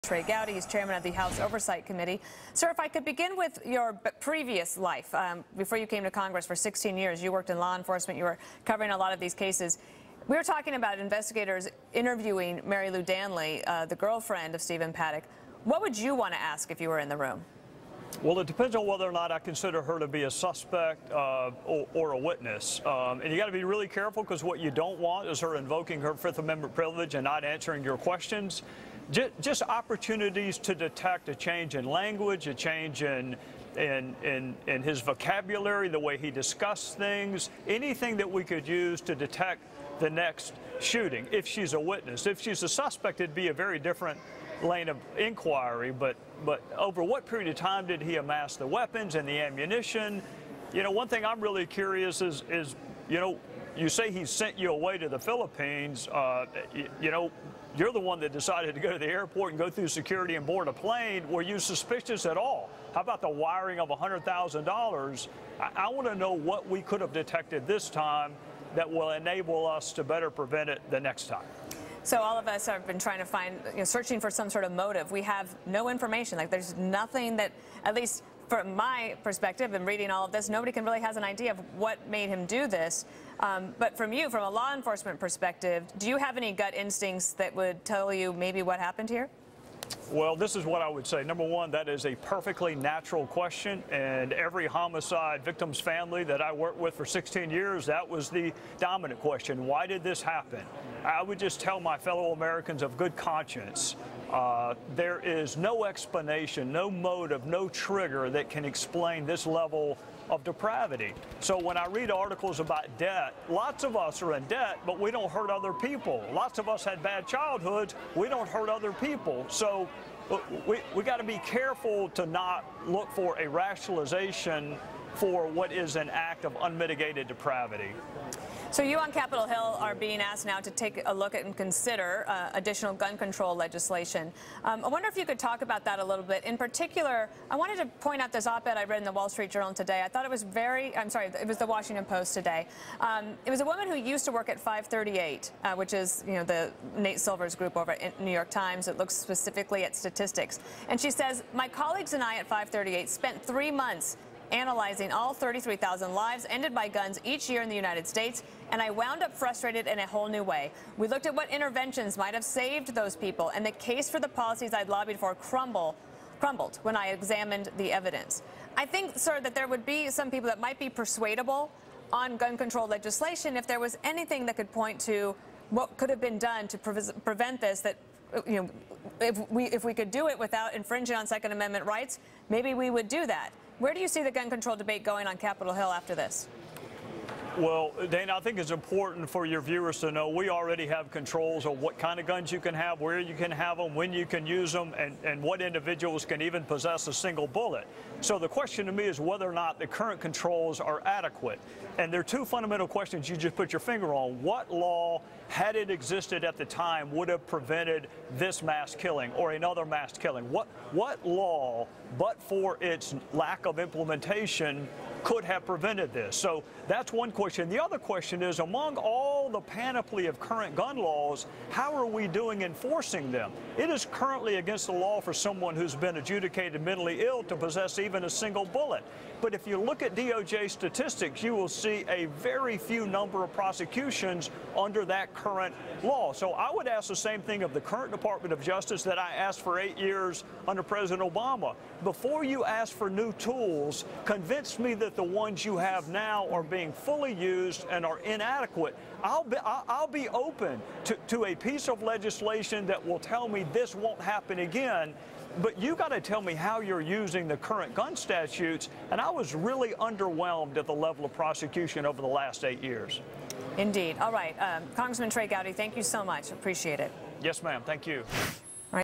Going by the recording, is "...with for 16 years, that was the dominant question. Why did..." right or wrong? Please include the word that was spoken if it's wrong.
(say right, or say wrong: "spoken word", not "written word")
right.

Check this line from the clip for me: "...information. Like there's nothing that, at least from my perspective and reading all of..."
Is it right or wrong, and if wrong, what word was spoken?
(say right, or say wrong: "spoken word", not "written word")
right.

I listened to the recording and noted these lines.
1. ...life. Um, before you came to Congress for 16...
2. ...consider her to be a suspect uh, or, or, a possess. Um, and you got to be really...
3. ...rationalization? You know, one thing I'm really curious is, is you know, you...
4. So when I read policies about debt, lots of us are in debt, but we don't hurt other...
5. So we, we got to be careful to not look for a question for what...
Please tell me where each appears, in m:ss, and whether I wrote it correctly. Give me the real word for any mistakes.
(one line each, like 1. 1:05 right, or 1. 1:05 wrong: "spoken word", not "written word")
1. 0:04 right
2. 0:19 wrong: "witness", not "possess"
3. 0:49 wrong: "ammunition", not "rationalization"
4. 1:51 wrong: "articles", not "policies"
5. 1:59 wrong: "rationalization", not "question".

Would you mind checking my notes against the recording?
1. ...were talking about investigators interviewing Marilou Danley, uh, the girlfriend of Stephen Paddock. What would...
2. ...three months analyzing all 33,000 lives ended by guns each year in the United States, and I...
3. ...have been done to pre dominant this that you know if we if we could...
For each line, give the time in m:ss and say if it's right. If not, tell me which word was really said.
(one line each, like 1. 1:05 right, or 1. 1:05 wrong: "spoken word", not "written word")
1. 0:10 right
2. 2:33 right
3. 2:56 wrong: "prevent", not "dominant".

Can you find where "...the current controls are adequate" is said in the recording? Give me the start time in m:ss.
3:19.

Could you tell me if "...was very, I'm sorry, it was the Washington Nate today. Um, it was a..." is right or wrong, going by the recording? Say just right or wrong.
wrong.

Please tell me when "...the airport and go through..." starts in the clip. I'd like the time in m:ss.
0:58.